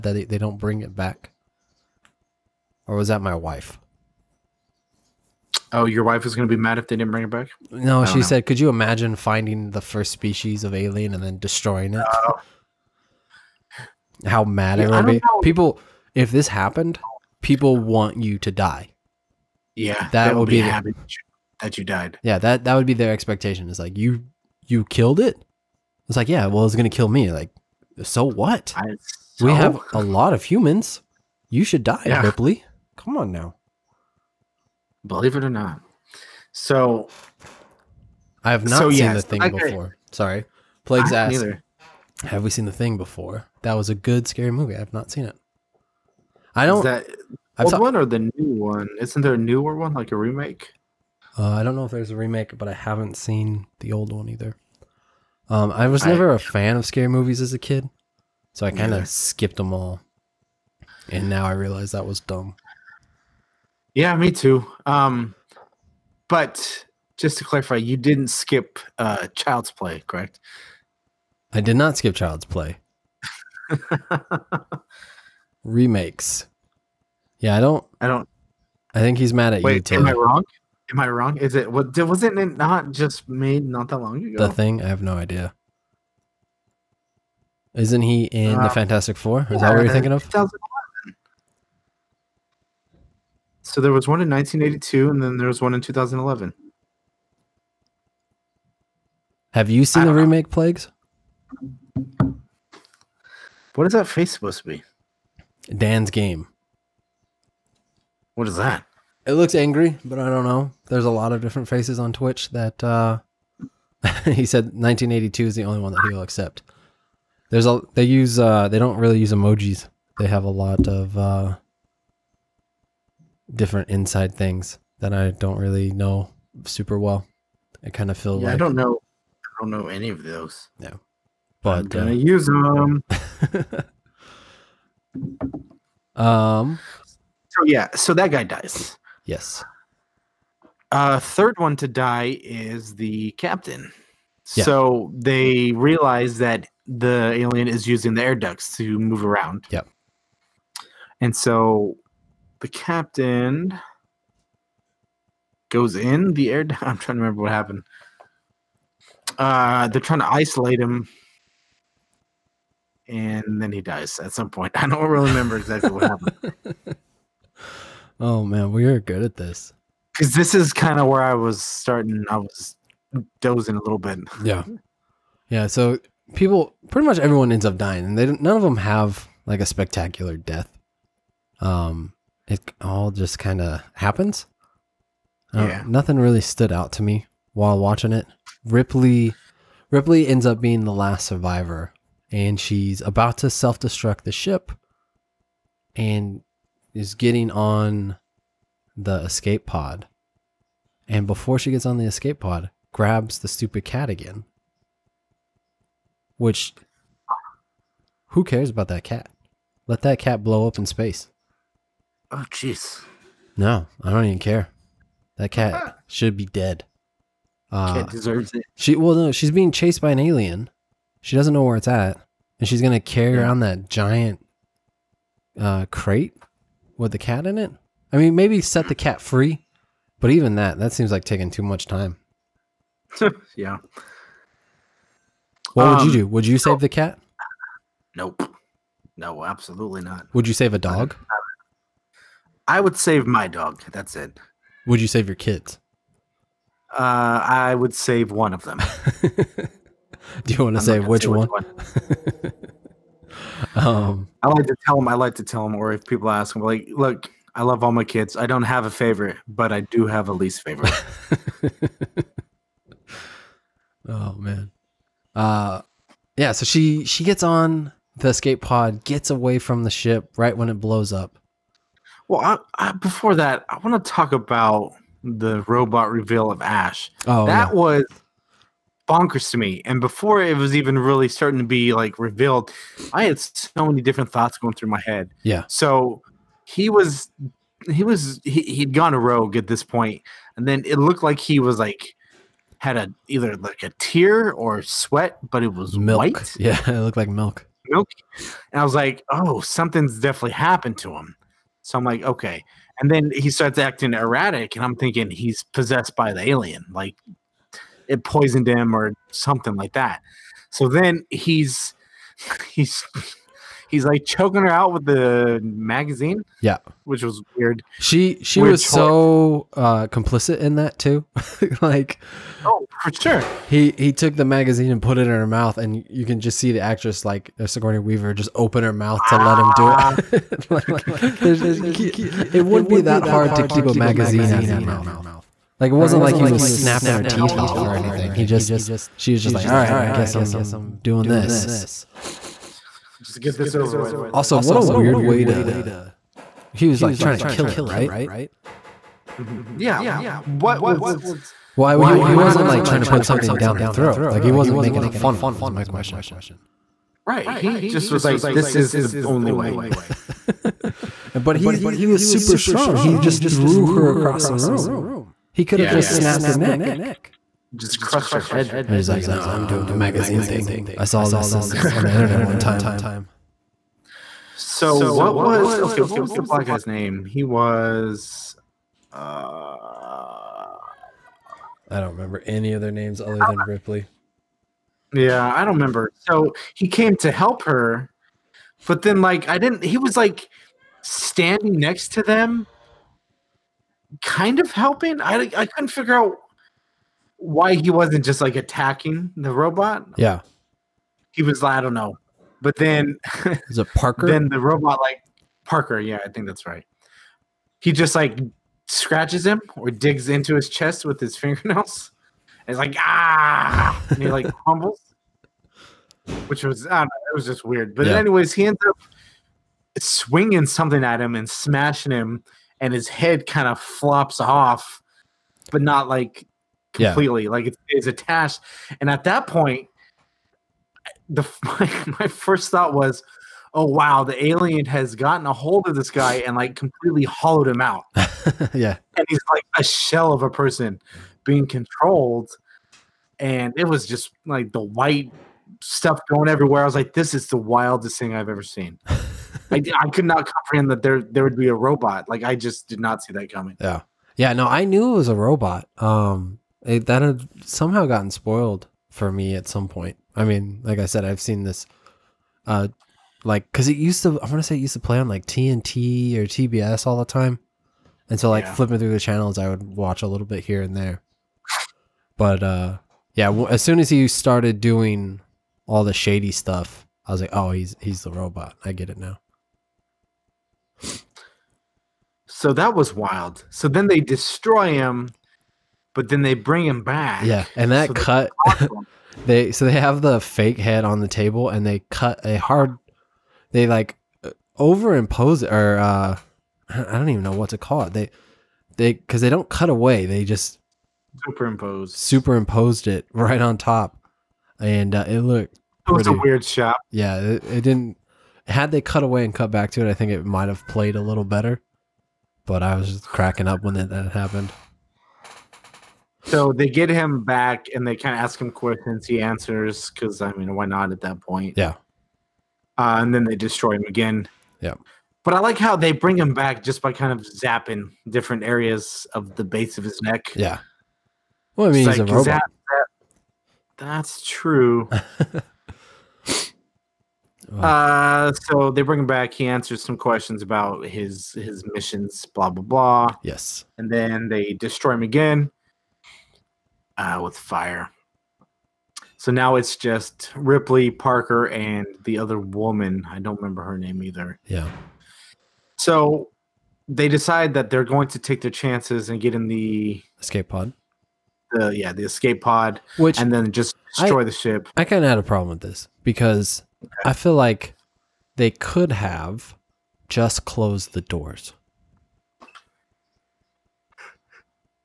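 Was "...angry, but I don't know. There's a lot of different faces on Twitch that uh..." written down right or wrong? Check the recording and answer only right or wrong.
right.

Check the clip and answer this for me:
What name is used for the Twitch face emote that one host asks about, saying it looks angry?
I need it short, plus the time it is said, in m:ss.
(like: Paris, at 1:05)
Dan's game, at 1:45.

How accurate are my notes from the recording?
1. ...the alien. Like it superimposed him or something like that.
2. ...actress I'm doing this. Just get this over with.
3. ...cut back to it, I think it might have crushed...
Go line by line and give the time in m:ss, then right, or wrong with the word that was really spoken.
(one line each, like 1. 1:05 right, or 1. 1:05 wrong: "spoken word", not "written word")
1. 5:06 wrong: "poisoned", not "superimposed"
2. 5:40 wrong: "guess", not "actress"
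3. 8:29 wrong: "played", not "crushed".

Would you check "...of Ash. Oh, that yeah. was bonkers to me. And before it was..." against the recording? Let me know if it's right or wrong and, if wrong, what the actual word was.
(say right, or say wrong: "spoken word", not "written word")
right.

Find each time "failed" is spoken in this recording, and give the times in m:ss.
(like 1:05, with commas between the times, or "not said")
not said.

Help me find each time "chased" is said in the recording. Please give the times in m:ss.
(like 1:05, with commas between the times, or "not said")
3:39.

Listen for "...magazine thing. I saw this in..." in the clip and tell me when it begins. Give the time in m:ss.
6:09.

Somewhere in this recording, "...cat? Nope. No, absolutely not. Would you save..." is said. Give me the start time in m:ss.
3:56.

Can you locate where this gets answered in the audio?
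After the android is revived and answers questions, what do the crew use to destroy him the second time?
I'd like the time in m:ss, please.
9:07.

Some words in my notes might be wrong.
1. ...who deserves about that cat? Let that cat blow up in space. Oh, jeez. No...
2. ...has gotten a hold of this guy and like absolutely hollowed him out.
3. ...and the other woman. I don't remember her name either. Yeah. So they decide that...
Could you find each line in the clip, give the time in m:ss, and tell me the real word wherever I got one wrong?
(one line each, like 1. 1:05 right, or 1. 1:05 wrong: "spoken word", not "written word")
1. 3:28 wrong: "cares", not "deserves"
2. 7:14 wrong: "completely", not "absolutely"
3. 9:11 right.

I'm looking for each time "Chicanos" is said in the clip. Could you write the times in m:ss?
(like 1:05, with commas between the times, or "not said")
not said.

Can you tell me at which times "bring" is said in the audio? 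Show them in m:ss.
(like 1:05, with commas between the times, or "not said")
0:00, 0:07, 8:06, 8:46, 8:59.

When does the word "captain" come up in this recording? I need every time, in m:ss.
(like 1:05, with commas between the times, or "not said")
2:23, 2:32.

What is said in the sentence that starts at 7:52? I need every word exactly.
But uh, yeah, as soon as he started doing all the shady stuff, I was like, oh, he's he's the robot.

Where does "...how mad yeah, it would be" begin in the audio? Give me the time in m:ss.
0:14.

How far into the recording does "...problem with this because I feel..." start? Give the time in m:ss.
9:25.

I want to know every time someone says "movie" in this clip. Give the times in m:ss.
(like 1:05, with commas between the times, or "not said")
0:44, 0:57.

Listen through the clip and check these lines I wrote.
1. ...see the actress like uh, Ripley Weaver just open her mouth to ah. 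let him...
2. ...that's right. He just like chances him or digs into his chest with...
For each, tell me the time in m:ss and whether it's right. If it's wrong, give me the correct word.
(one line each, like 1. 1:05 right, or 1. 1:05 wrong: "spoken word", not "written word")
1. 5:26 wrong: "Sigourney", not "Ripley"
2. 6:46 wrong: "scratches", not "chances".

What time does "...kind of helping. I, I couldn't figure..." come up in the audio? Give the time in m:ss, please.
6:34.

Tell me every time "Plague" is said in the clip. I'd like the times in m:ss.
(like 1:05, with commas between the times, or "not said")
0:40, 1:40.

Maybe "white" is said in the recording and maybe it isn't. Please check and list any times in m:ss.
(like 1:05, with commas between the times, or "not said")
4:56, 7:24.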